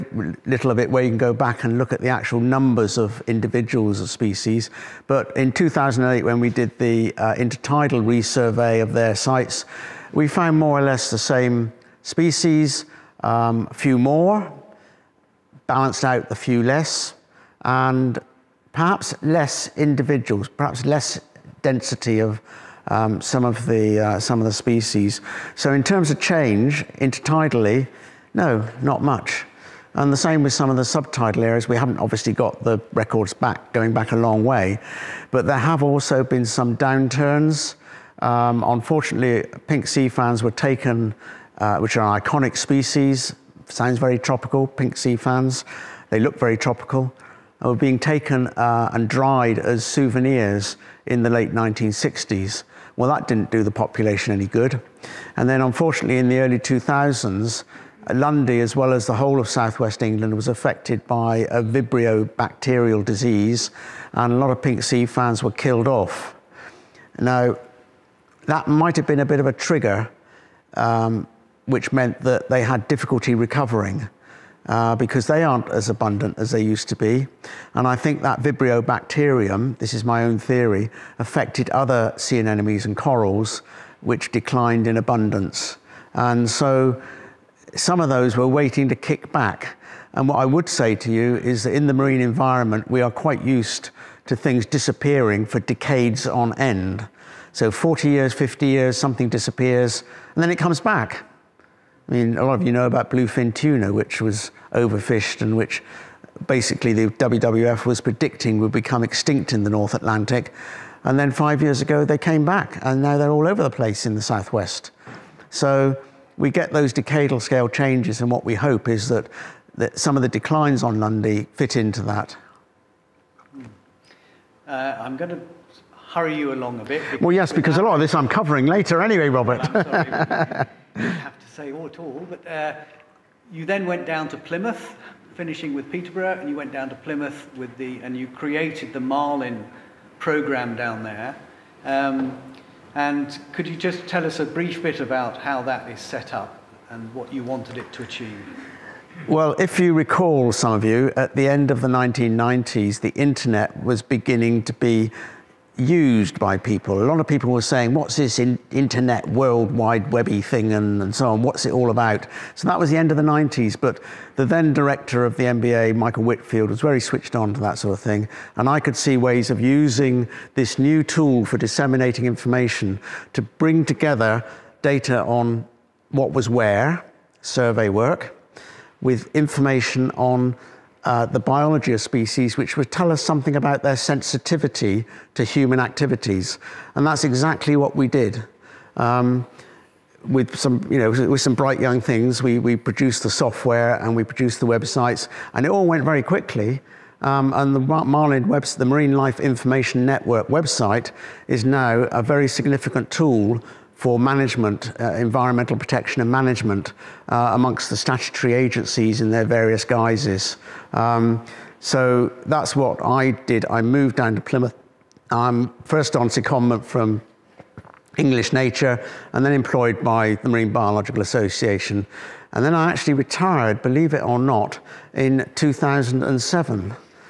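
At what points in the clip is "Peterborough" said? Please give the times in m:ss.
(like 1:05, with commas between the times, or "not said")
2:15.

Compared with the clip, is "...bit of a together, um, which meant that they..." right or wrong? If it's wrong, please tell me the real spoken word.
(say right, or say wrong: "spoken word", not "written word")
wrong: "trigger", not "together".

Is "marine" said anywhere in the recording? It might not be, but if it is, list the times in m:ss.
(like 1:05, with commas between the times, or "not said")
1:31, 3:18, 3:40.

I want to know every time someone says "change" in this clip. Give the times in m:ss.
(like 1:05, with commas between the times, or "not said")
0:26, 1:57.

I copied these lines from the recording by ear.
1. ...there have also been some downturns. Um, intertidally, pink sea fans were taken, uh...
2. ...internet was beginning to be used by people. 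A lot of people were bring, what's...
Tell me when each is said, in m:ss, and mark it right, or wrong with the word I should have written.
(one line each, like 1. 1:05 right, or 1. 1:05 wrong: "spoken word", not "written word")
1. 0:35 wrong: "unfortunately", not "intertidally"
2. 2:33 wrong: "saying", not "bring".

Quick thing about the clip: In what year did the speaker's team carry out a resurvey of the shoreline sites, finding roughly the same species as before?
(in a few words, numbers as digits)
2008.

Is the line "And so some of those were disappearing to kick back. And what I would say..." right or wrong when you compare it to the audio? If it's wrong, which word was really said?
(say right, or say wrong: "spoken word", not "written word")
wrong: "waiting", not "disappearing".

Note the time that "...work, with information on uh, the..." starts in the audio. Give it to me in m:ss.
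2:57.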